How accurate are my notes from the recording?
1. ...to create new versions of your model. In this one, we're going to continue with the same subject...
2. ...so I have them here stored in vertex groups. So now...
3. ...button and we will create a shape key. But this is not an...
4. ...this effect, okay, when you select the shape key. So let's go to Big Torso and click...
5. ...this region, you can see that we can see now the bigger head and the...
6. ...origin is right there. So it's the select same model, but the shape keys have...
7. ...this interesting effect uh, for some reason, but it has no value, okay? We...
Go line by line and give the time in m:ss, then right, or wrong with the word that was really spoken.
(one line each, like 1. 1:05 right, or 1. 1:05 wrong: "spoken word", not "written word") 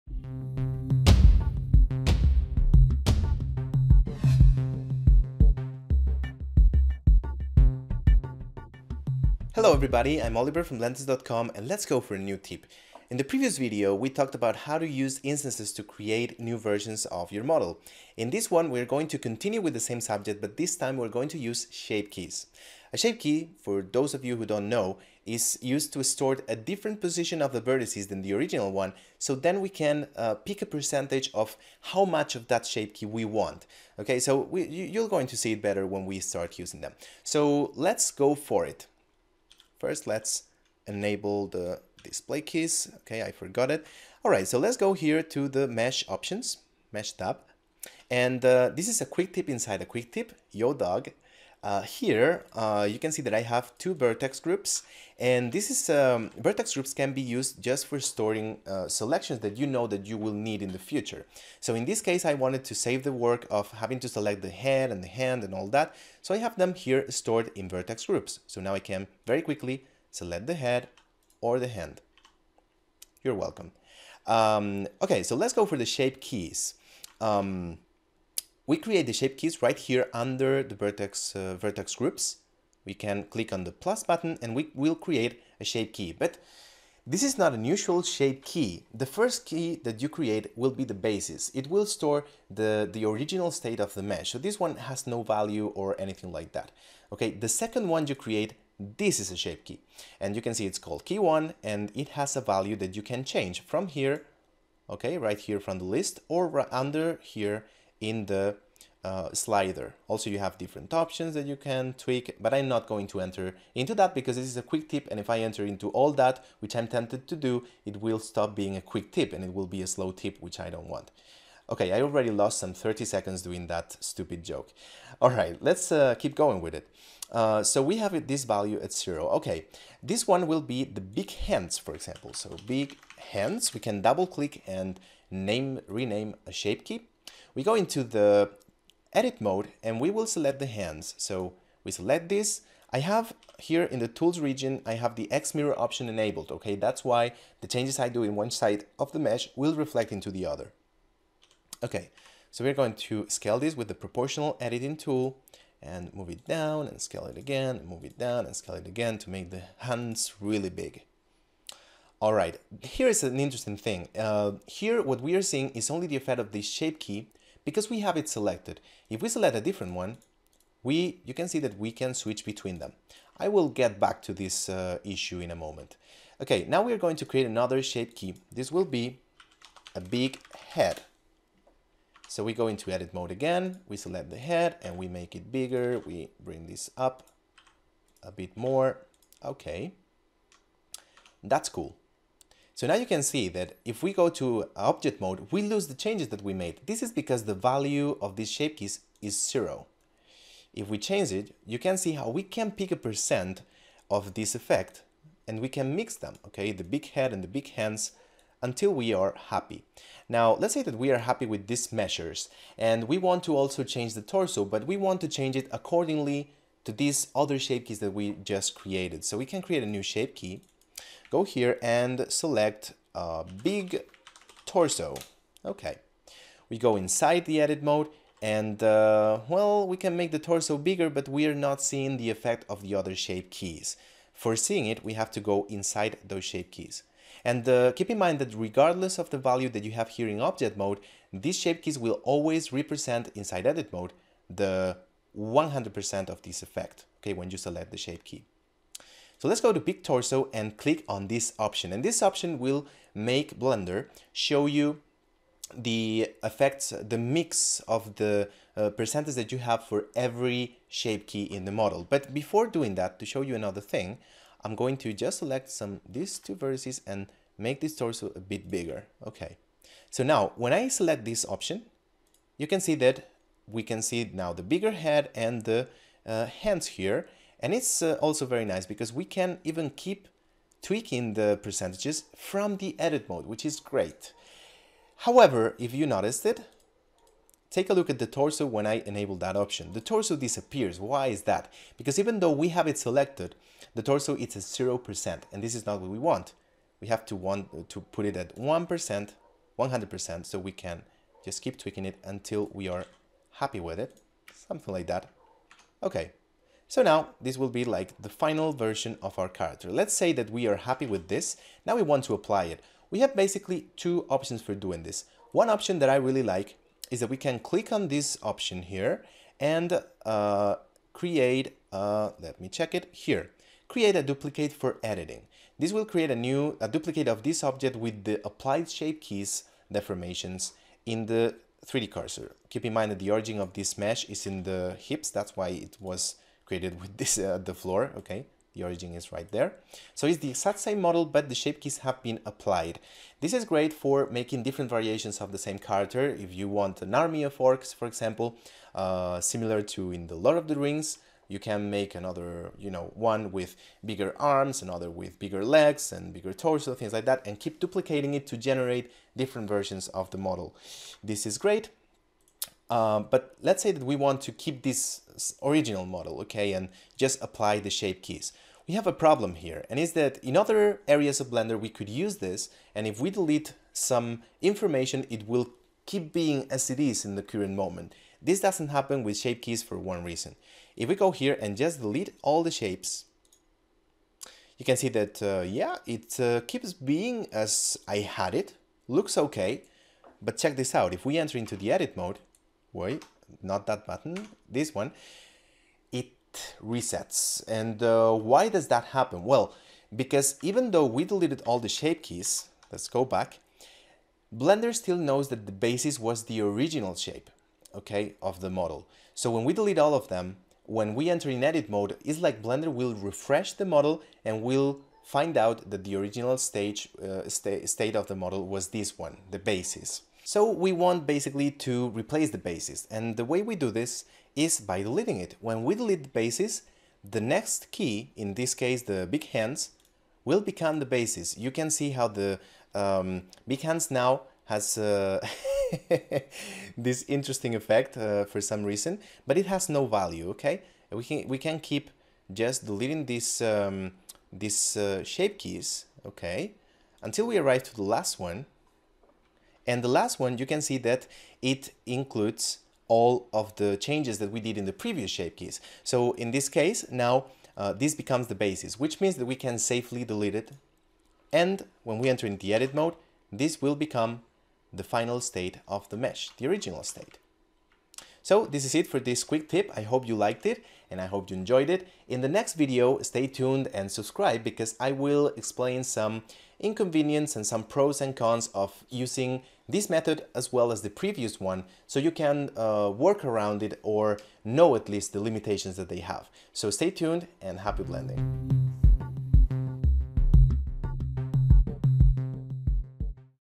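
1. 0:15 right
2. 1:06 right
3. 1:24 right
4. 4:06 right
5. 4:31 wrong: "option", not "region"
6. 5:38 wrong: "exact", not "select"
7. 7:16 right.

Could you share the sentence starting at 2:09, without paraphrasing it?
Okay, this one will be the big hands, for example.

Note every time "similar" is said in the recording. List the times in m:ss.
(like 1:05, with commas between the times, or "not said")
5:49.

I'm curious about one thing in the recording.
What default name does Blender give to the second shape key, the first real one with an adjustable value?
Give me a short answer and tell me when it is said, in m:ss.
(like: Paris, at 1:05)
Key one, at 1:41.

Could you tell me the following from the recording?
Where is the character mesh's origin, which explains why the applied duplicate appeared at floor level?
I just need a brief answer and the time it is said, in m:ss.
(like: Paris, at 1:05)
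In the hips, at 5:34.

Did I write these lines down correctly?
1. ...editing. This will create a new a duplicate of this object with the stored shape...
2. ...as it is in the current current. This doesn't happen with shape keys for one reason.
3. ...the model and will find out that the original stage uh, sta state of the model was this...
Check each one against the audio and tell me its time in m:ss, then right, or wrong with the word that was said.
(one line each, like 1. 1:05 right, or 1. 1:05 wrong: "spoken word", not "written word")
1. 5:25 wrong: "applied", not "stored"
2. 6:16 wrong: "moment", not "current"
3. 6:53 right.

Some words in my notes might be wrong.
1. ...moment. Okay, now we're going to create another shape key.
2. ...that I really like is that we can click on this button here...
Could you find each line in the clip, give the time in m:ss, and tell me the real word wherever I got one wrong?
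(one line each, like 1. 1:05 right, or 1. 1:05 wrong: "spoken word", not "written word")
1. 2:55 right
2. 5:15 wrong: "option", not "button".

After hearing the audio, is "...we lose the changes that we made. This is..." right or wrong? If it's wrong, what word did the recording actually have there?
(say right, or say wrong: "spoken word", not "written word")
right.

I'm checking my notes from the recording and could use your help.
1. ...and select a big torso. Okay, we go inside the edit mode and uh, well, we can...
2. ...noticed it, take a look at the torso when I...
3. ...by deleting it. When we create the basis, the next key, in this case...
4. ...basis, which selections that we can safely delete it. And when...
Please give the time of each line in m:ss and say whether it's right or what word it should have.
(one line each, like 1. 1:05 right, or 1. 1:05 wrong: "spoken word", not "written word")
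1. 3:41 right
2. 4:46 right
3. 7:04 wrong: "delete", not "create"
4. 7:38 wrong: "means", not "selections".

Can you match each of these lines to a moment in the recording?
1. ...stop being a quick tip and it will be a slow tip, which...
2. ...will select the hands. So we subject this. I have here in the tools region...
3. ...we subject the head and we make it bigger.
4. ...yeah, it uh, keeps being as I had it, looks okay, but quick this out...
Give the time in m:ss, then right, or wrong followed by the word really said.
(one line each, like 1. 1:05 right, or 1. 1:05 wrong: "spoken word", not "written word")
1. 1:58 right
2. 2:20 wrong: "select", not "subject"
3. 3:03 wrong: "select", not "subject"
4. 6:25 wrong: "check", not "quick".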